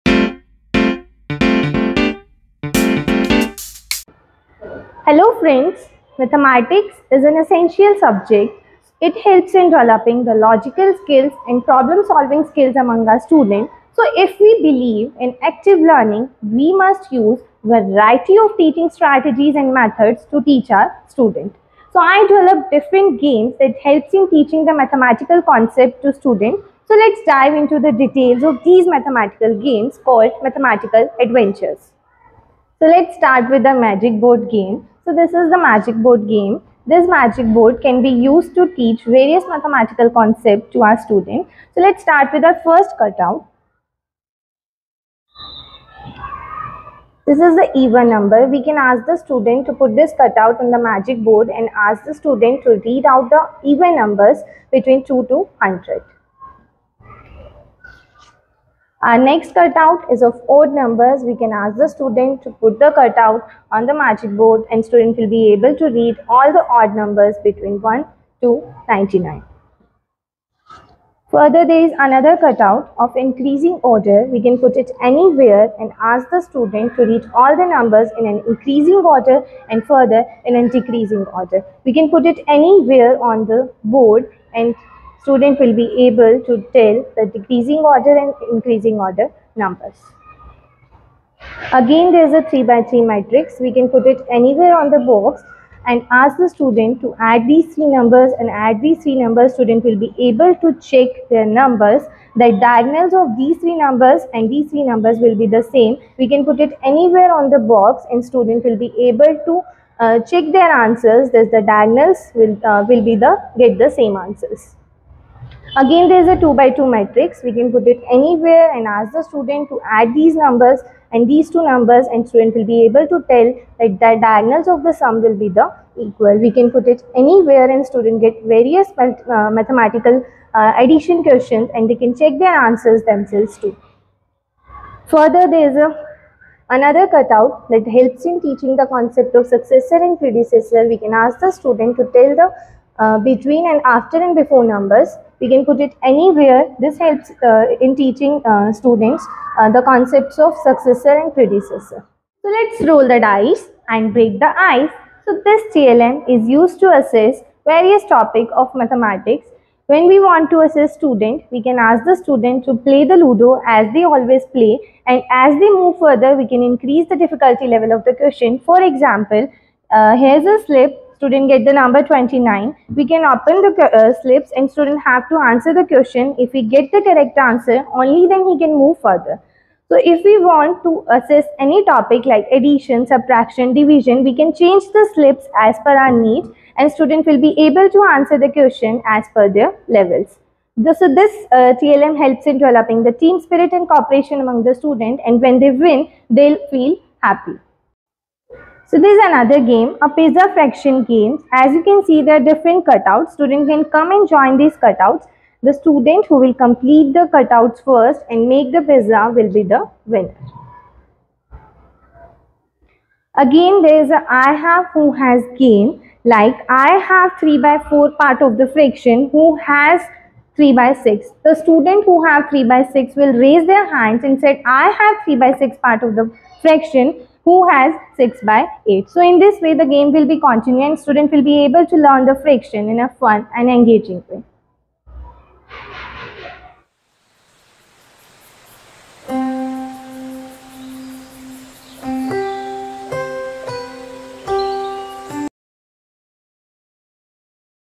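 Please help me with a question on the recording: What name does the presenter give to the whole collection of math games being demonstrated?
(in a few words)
Mathematical adventures.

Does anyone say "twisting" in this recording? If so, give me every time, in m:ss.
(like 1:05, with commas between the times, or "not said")
not said.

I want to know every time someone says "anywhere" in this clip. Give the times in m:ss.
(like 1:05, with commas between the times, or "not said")
1:15, 1:22, 1:34, 1:46, 1:58, 2:07, 2:26.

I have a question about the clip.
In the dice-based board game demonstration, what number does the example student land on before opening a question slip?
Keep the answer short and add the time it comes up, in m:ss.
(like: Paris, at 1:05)
29, at 2:52.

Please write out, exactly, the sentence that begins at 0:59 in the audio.
Our next cutout is of odd numbers.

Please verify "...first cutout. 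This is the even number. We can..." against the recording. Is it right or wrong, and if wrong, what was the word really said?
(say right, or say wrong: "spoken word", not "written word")
right.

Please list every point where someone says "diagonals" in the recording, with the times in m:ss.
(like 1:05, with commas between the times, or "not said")
1:42, 1:51, 2:04.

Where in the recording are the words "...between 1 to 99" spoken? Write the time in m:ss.
1:07.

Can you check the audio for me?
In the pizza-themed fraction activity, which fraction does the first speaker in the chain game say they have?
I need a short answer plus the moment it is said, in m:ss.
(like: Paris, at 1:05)
3/4, at 3:37.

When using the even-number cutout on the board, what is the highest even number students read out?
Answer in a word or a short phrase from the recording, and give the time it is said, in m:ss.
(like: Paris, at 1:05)
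100, at 0:55.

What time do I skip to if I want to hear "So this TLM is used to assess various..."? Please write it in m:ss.
2:35.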